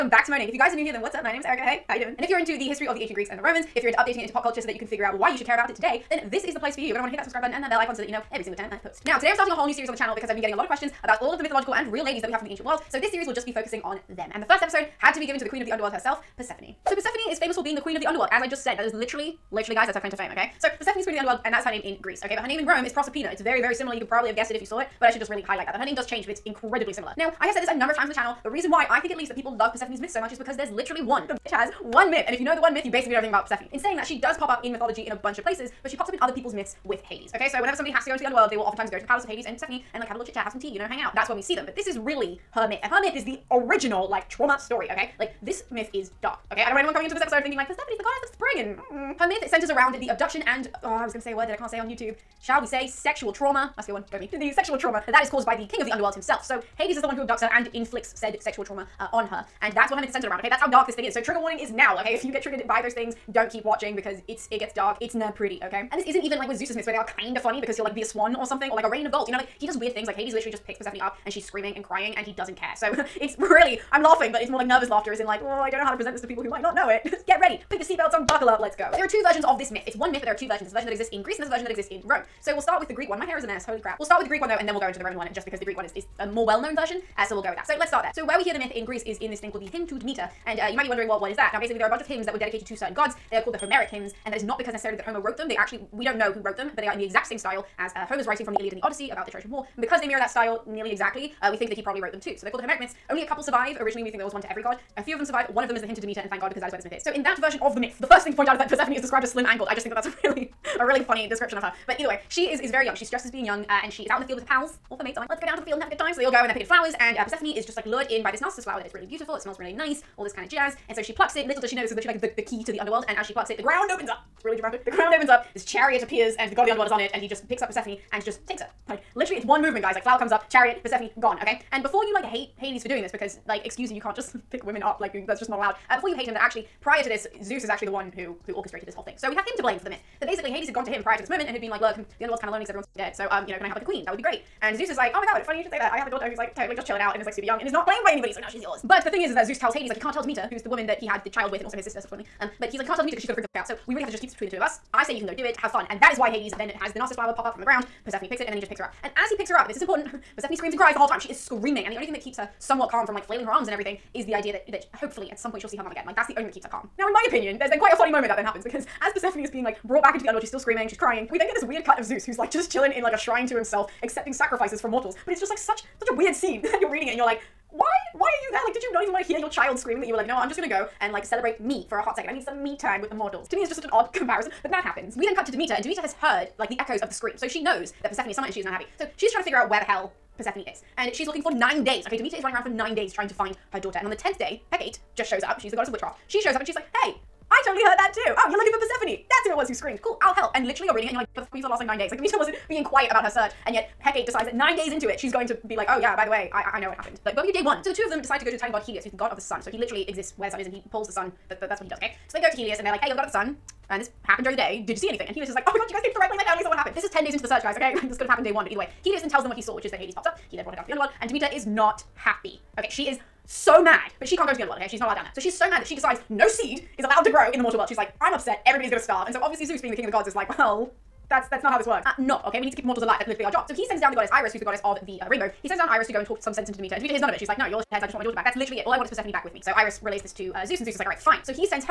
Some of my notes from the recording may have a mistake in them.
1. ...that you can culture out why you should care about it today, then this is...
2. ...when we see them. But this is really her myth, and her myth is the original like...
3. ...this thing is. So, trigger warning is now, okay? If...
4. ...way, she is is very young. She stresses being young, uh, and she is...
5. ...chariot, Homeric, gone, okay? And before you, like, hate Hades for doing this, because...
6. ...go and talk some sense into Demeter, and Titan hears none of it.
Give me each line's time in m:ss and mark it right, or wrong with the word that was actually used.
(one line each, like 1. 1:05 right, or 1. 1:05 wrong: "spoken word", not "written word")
1. 0:04 wrong: "figure", not "culture"
2. 0:41 right
3. 1:00 right
4. 1:52 right
5. 2:10 wrong: "Persephone", not "Homeric"
6. 3:56 wrong: "Demeter", not "Titan".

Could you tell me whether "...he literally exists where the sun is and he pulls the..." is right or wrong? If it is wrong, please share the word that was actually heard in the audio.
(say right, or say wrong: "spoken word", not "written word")
right.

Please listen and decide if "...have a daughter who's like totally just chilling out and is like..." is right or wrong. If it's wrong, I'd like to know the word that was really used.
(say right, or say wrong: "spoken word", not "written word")
right.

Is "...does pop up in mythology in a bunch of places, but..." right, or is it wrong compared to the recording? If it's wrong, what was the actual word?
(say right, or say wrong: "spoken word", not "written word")
right.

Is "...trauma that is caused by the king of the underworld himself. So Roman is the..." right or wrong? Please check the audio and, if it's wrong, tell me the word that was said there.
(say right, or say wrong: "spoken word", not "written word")
wrong: "Hades", not "Roman".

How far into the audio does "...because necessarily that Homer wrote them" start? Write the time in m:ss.
1:34.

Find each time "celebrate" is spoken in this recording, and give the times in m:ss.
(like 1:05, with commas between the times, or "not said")
3:01.